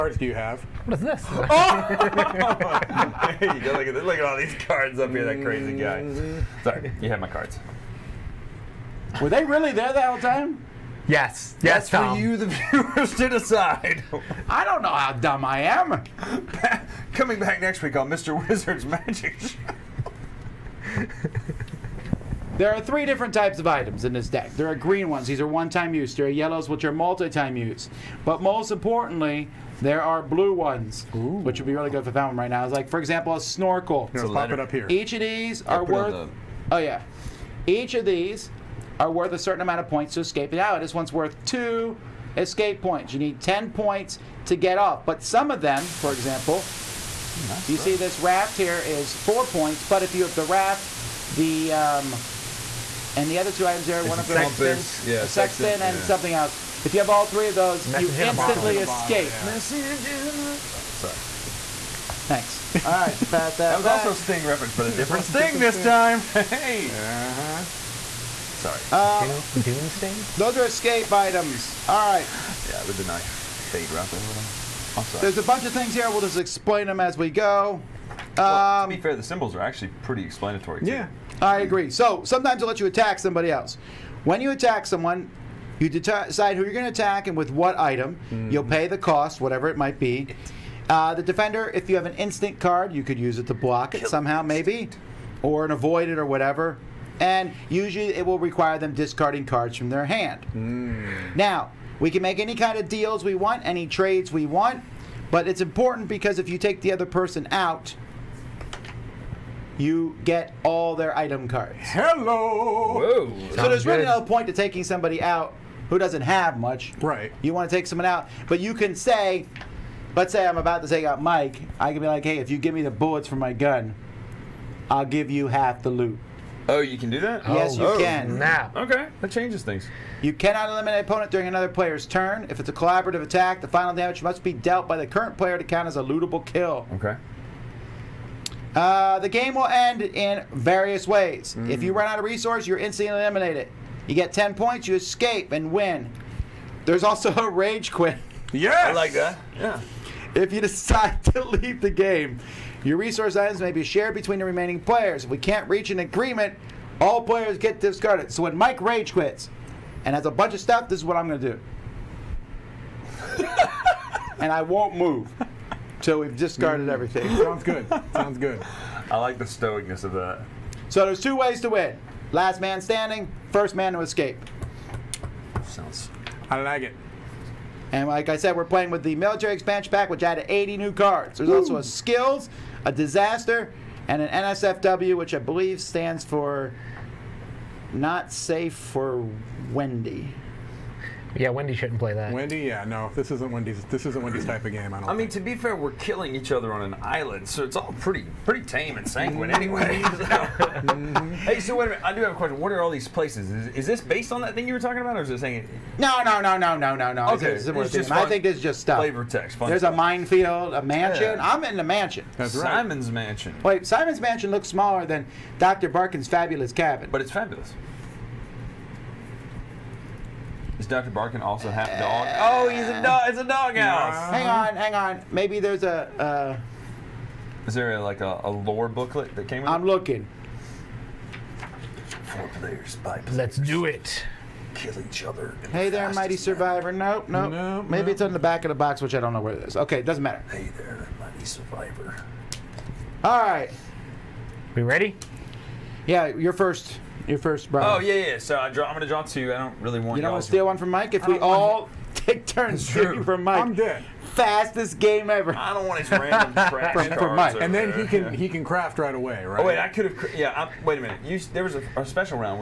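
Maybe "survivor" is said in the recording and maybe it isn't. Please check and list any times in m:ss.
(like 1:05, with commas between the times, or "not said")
3:56, 4:01.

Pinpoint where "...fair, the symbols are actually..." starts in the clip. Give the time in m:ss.
1:18.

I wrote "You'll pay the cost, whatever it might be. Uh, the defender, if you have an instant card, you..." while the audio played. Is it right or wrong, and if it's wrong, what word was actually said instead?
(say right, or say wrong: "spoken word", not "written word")
right.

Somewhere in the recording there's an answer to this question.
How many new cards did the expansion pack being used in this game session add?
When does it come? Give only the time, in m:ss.
3:00.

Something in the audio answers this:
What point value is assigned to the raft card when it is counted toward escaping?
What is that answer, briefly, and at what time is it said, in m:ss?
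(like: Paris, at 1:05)
4, at 0:48.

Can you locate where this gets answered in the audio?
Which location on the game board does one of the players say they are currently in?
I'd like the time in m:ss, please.
3:31.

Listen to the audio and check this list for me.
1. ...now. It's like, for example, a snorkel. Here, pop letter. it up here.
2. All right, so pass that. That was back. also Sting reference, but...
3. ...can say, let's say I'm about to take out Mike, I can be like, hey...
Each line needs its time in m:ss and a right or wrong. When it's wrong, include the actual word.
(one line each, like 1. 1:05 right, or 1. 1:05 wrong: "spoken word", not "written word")
1. 0:32 right
2. 1:02 right
3. 1:58 right.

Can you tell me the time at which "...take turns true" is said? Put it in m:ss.
4:12.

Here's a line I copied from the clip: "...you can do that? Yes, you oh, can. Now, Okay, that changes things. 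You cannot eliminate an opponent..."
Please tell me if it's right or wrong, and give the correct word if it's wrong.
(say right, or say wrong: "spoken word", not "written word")
right.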